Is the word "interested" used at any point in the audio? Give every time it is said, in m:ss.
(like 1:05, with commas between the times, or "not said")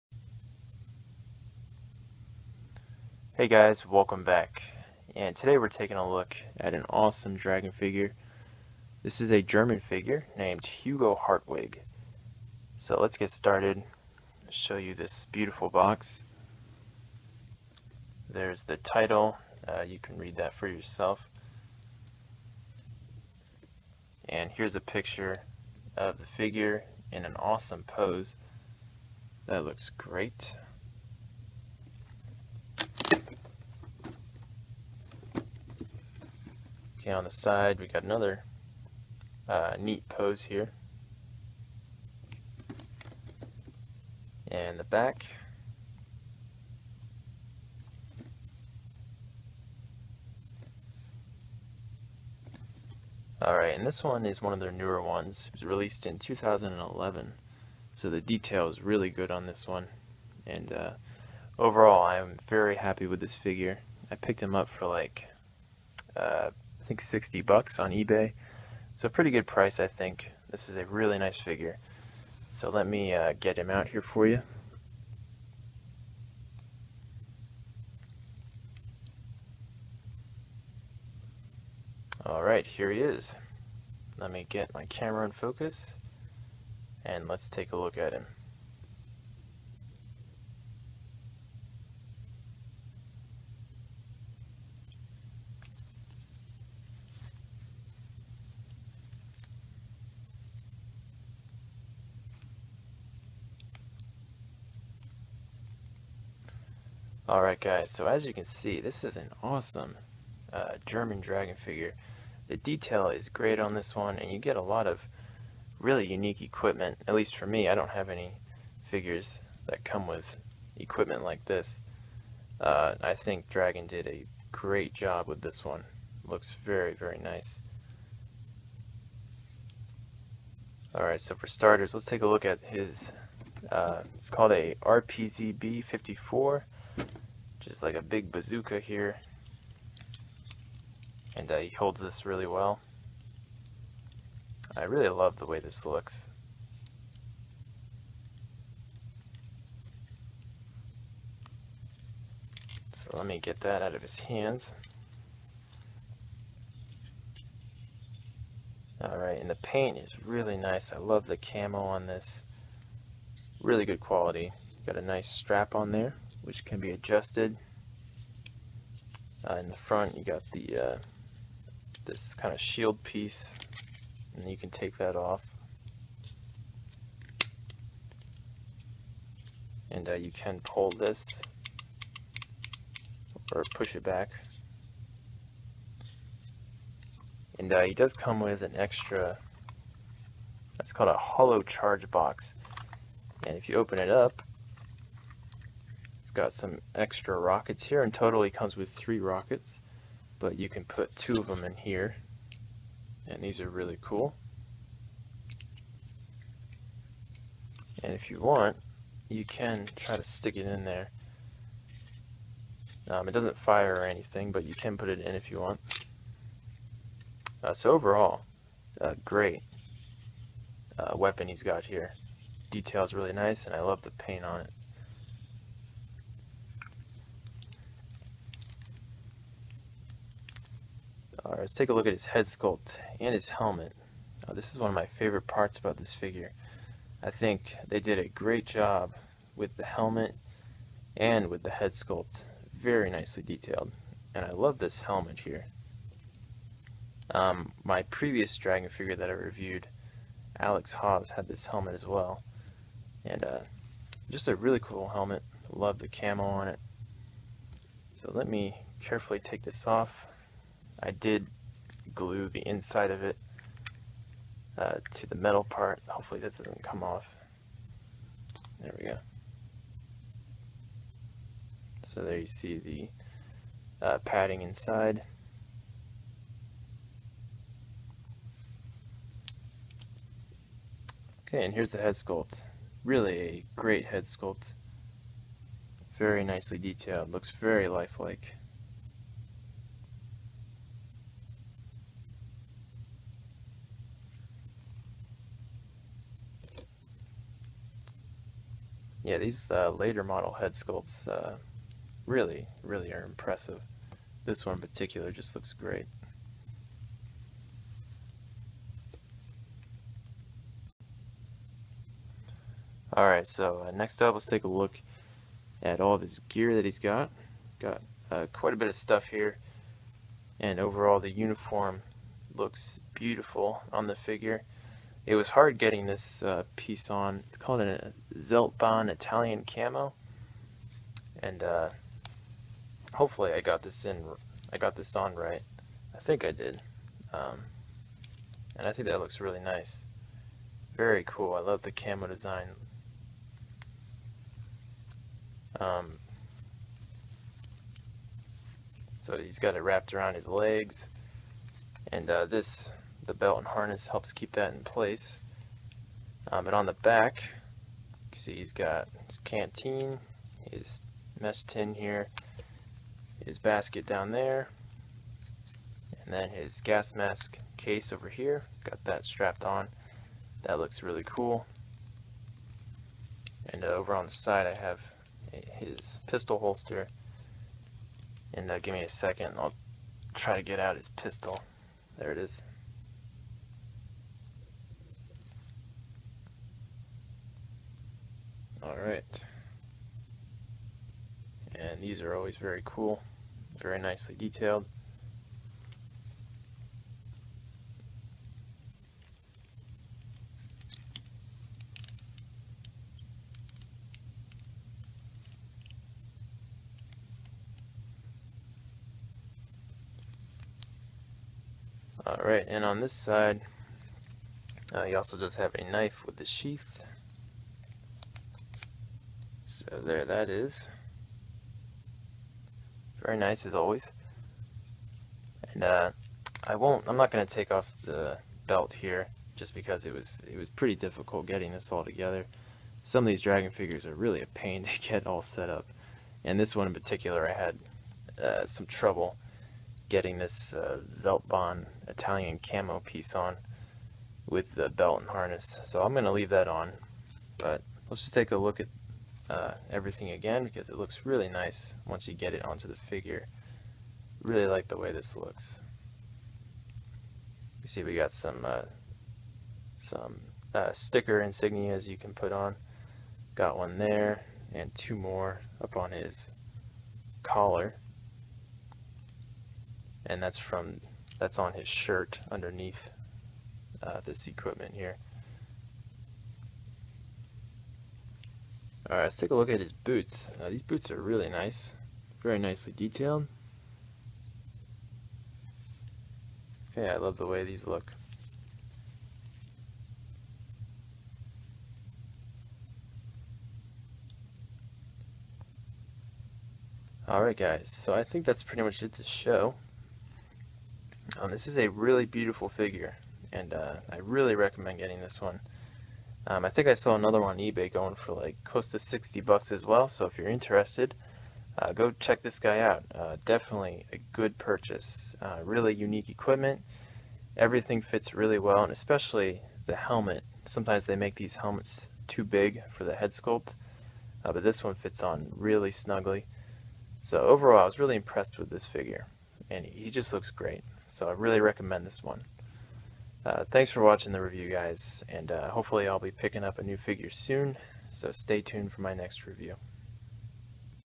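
8:30.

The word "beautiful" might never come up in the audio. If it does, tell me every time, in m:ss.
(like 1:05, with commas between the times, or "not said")
0:15, 5:23, 8:22.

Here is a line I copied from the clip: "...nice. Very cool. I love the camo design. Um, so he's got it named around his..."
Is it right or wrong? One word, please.
wrong.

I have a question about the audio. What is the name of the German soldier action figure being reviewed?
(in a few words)
Hugo Hartwig.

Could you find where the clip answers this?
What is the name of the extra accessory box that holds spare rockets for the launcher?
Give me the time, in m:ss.
3:11.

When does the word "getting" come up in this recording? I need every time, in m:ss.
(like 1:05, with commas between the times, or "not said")
5:25, 7:11, 7:20, 8:24.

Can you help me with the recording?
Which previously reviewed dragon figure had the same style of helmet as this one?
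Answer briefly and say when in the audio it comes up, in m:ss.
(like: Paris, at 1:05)
Alex Hawes, at 4:10.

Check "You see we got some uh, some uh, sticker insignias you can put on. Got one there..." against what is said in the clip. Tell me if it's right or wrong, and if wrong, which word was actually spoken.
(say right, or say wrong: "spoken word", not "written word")
right.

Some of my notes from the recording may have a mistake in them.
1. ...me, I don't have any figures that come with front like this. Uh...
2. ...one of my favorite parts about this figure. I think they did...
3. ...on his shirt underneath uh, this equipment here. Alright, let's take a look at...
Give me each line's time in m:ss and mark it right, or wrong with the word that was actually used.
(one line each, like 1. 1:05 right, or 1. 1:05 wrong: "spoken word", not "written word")
1. 1:57 wrong: "equipment", not "front"
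2. 3:54 right
3. 7:51 right.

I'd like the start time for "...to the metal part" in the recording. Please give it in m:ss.
4:25.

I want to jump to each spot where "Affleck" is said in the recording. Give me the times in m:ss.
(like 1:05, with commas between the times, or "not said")
not said.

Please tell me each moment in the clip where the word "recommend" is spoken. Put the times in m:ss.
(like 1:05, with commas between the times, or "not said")
8:24, 8:51.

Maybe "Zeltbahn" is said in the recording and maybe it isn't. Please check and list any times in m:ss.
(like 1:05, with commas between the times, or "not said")
5:28, 7:21.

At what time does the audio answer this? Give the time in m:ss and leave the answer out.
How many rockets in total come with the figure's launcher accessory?
3:18.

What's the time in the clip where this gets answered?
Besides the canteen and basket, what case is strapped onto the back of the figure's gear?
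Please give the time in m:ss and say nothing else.
6:06.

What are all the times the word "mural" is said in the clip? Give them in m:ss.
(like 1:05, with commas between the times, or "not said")
not said.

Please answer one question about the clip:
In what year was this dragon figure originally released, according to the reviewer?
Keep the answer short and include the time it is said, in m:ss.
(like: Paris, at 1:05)
2011, at 0:56.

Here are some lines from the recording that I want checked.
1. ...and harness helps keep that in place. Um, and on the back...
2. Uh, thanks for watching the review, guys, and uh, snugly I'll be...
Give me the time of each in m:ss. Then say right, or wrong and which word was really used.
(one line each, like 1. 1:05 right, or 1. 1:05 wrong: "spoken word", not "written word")
1. 5:53 right
2. 8:53 wrong: "hopefully", not "snugly".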